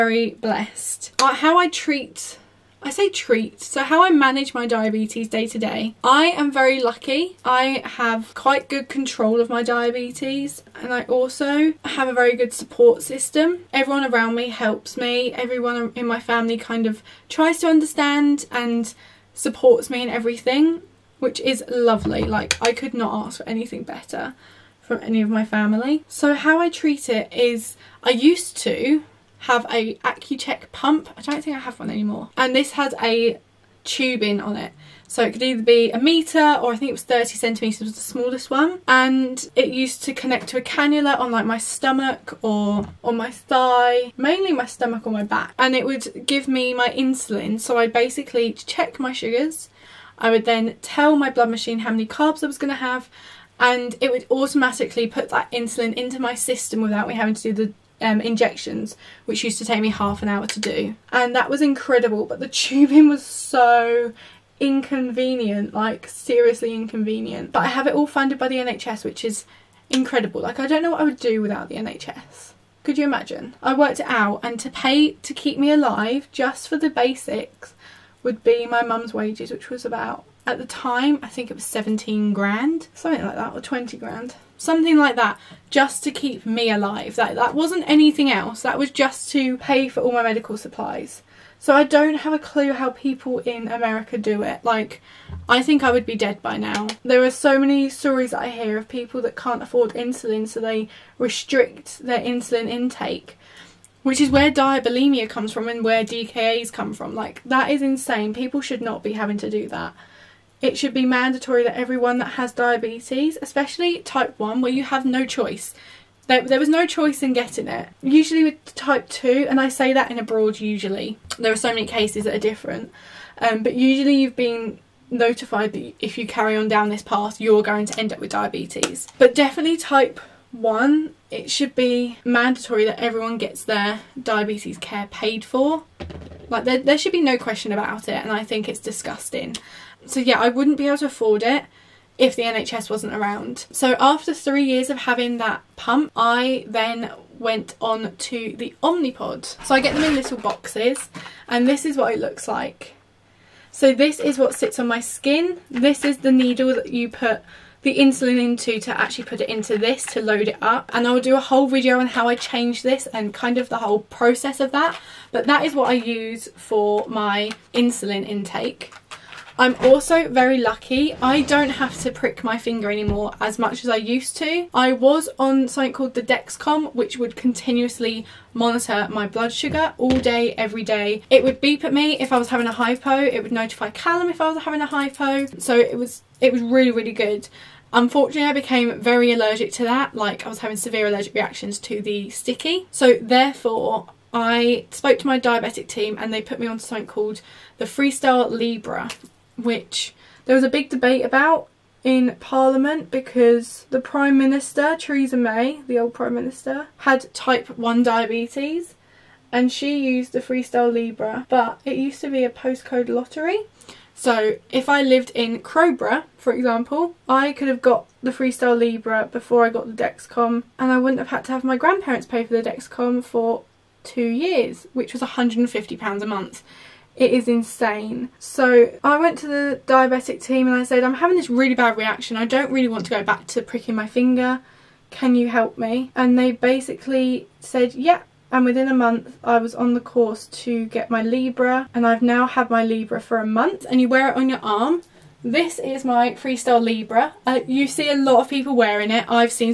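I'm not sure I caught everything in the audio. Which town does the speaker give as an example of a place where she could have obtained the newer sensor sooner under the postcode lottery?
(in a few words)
Crowborough.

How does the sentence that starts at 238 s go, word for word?
And within a month, I was on the course to get my Libre.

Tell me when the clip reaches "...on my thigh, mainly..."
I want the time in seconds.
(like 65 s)
43 s.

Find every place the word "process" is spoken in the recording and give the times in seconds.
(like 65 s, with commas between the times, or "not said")
164 s.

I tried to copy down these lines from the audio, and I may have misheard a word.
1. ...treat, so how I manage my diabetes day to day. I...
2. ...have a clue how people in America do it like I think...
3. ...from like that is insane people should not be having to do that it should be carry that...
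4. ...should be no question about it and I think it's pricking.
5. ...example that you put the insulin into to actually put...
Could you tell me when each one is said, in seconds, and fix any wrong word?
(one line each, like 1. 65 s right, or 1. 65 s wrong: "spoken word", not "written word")
1. 3 s right
2. 92 s right
3. 106 s wrong: "mandatory", not "carry"
4. 136 s wrong: "disgusting", not "pricking"
5. 156 s wrong: "needle", not "example".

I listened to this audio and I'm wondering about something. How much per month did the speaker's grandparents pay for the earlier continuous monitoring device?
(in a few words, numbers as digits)
£150.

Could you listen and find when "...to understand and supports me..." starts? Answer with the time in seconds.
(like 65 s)
17 s.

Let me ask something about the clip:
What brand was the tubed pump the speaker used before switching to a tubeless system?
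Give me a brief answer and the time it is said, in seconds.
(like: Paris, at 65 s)
Accu-Chek, at 29 s.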